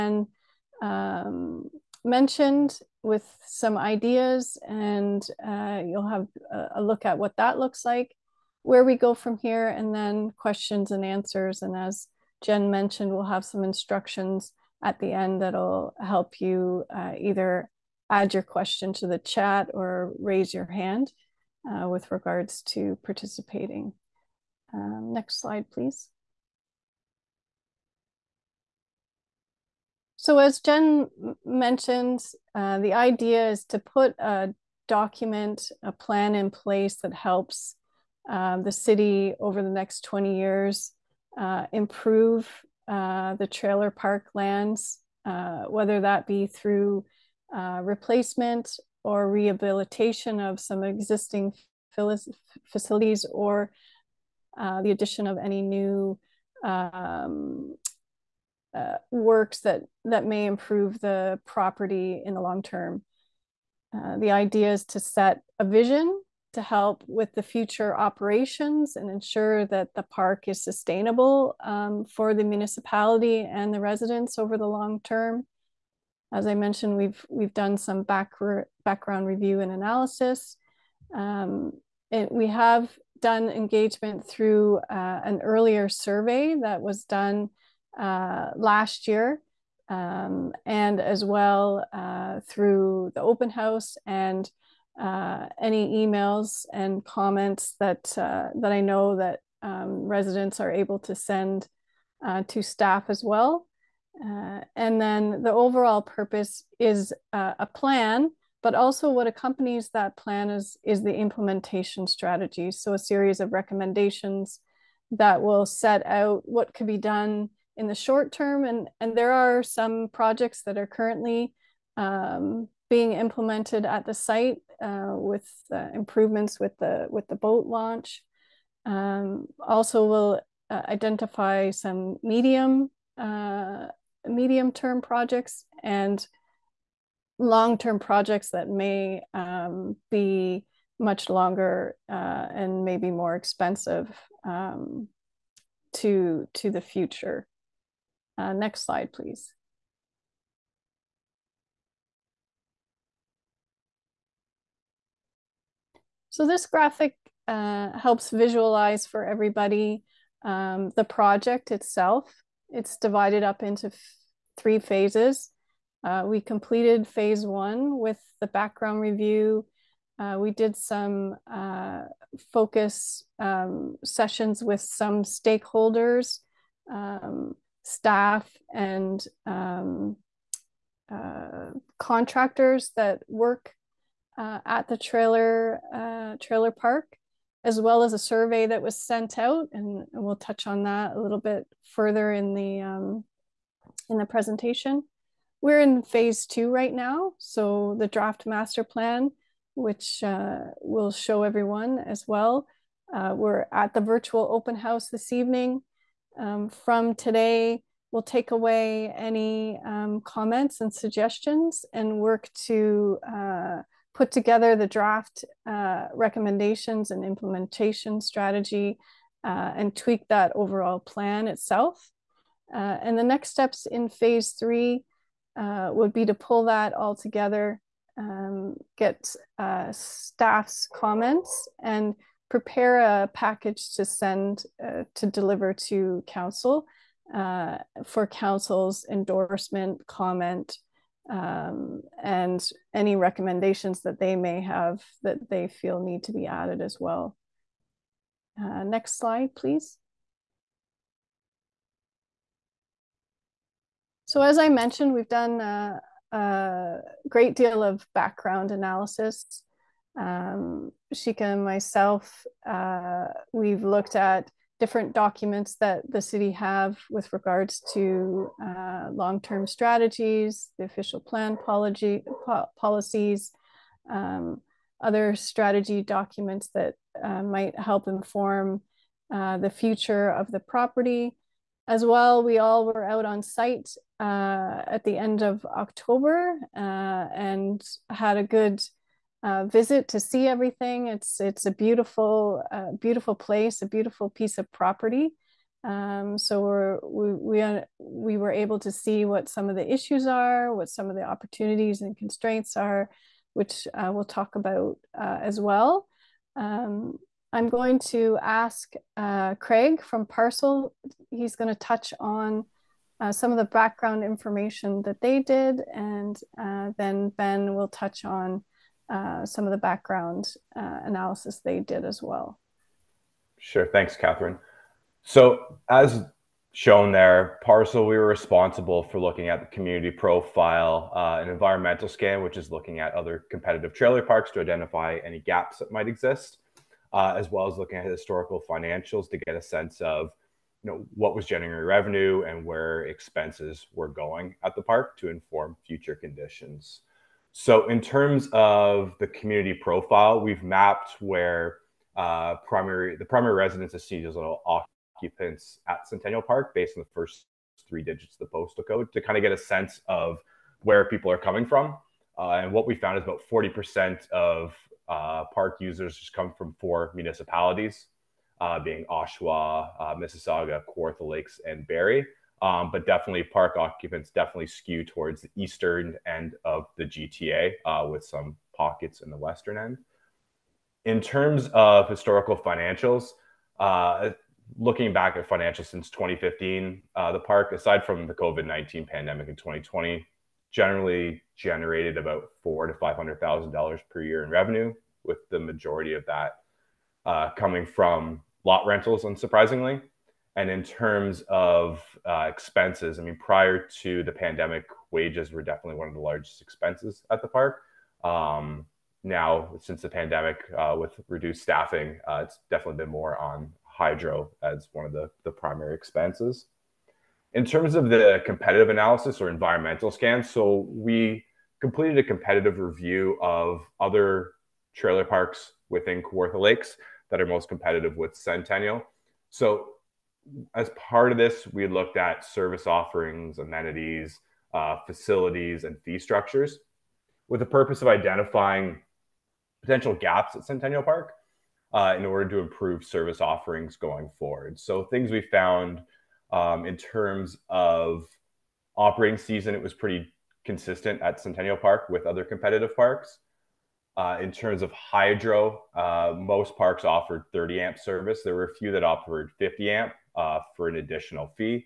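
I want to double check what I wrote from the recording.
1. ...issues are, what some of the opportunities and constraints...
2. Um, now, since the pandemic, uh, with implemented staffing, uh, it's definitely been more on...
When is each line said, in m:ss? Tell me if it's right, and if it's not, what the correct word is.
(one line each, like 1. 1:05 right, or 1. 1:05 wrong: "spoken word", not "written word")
1. 4:59 right
2. 6:48 wrong: "reduced", not "implemented".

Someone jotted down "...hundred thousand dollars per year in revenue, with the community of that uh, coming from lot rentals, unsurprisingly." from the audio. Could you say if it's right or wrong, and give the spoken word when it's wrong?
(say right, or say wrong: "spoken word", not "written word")
wrong: "majority", not "community".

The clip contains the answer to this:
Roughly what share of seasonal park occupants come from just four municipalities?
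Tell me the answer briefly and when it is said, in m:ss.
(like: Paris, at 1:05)
40%, at 6:03.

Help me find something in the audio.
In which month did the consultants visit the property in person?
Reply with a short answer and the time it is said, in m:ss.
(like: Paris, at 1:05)
October, at 4:45.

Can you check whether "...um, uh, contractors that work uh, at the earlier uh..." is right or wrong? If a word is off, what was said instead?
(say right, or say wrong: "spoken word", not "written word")
wrong: "trailer", not "earlier".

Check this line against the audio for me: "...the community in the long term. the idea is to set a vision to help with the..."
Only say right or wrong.
wrong.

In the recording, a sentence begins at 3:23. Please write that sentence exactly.
Uh, we're at the virtual open house this evening.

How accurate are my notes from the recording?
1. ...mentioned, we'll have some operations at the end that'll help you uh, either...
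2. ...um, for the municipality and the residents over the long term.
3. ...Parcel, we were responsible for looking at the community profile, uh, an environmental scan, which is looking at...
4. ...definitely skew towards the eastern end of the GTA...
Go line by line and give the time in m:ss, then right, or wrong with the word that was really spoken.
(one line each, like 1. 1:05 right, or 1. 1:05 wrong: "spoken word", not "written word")
1. 0:12 wrong: "instructions", not "operations"
2. 1:11 right
3. 5:27 right
4. 6:14 right.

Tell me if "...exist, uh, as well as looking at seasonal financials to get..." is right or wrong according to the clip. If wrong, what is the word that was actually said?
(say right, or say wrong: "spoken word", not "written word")
wrong: "historical", not "seasonal".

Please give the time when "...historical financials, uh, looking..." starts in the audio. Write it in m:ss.
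6:22.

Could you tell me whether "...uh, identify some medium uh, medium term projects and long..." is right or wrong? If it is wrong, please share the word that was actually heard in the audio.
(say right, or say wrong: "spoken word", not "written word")
right.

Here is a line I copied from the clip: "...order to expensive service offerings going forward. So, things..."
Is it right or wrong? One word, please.
wrong.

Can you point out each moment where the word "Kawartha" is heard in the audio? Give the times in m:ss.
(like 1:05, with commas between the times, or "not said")
6:10, 7:06.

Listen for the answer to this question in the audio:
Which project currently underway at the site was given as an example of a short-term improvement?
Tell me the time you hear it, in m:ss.
2:07.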